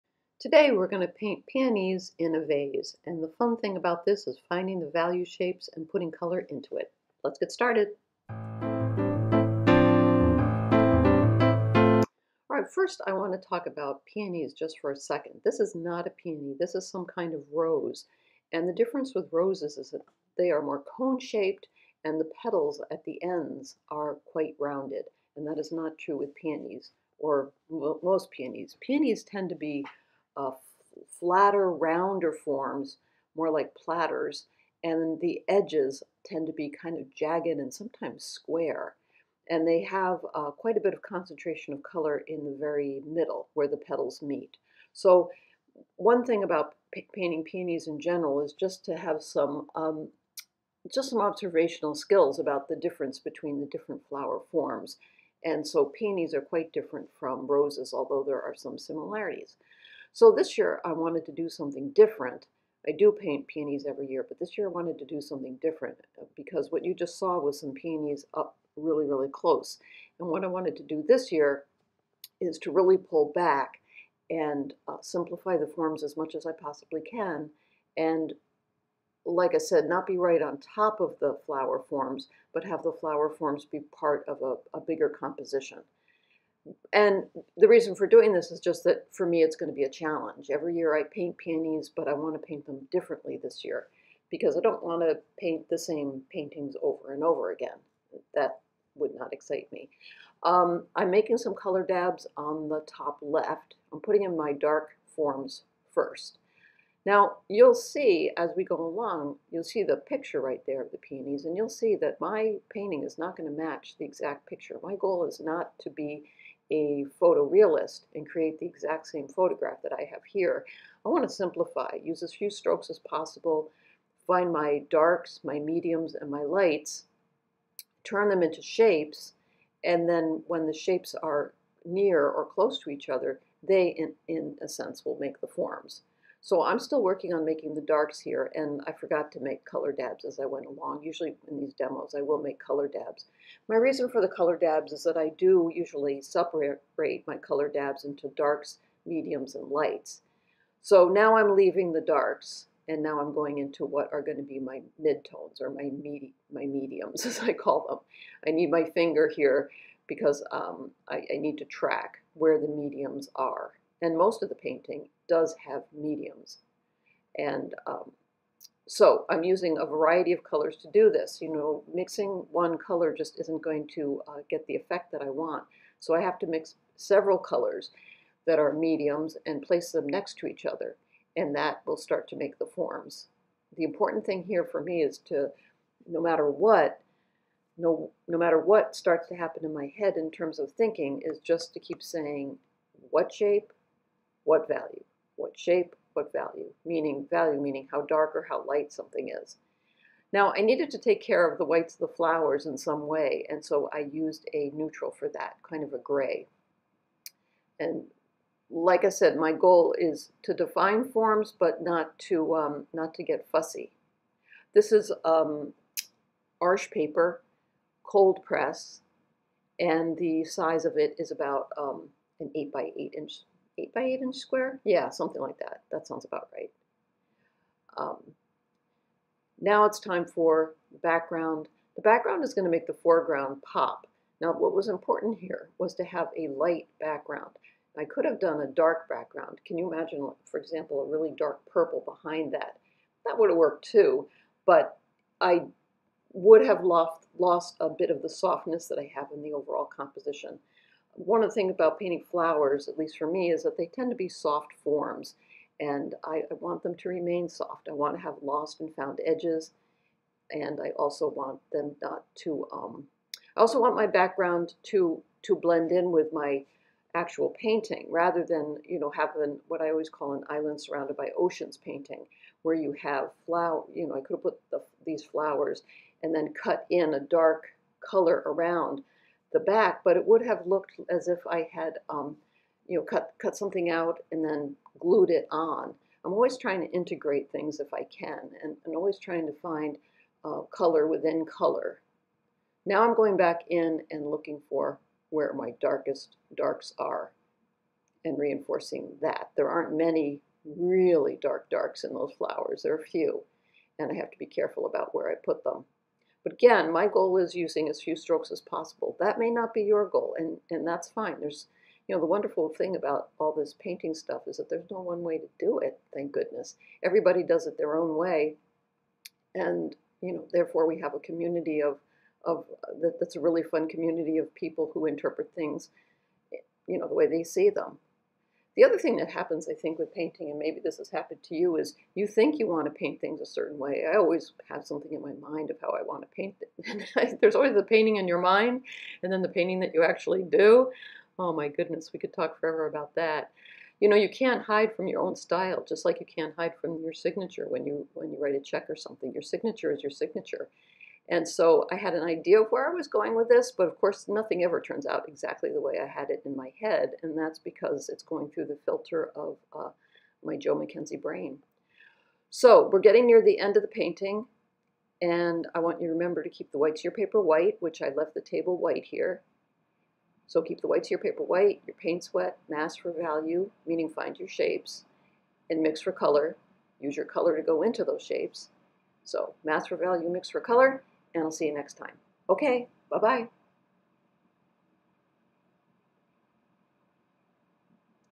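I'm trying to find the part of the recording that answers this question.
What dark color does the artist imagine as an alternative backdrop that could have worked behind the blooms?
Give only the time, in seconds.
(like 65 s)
241 s.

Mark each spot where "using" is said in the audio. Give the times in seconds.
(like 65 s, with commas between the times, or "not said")
169 s, 307 s.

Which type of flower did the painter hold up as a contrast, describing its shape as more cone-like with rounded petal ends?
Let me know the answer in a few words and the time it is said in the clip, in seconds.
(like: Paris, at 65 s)
Rose, at 16 s.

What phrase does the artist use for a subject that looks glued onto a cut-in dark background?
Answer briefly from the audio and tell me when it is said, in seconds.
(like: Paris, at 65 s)
Island surrounded by oceans, at 270 s.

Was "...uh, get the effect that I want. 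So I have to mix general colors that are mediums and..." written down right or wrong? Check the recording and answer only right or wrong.
wrong.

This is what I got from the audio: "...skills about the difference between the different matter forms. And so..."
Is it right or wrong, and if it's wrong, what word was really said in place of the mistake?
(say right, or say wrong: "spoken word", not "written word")
wrong: "flower", not "matter".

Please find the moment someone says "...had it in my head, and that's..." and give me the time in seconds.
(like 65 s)
356 s.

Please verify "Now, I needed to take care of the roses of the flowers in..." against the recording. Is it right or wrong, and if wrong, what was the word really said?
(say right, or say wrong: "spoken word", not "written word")
wrong: "whites", not "roses".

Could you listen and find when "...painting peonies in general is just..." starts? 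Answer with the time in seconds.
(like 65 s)
47 s.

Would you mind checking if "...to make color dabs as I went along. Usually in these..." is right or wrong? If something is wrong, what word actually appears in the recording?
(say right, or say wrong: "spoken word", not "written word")
right.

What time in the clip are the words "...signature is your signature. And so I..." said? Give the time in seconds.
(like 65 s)
349 s.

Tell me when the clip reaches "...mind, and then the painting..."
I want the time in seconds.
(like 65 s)
338 s.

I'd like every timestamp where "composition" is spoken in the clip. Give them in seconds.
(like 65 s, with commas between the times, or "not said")
85 s, 249 s.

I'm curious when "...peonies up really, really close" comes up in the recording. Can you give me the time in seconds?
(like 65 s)
67 s.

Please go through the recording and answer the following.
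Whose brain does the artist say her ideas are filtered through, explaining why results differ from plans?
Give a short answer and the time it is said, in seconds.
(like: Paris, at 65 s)
Jo MacKenzie, at 360 s.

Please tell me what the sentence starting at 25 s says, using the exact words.
And that is not true with peonies, or most peonies.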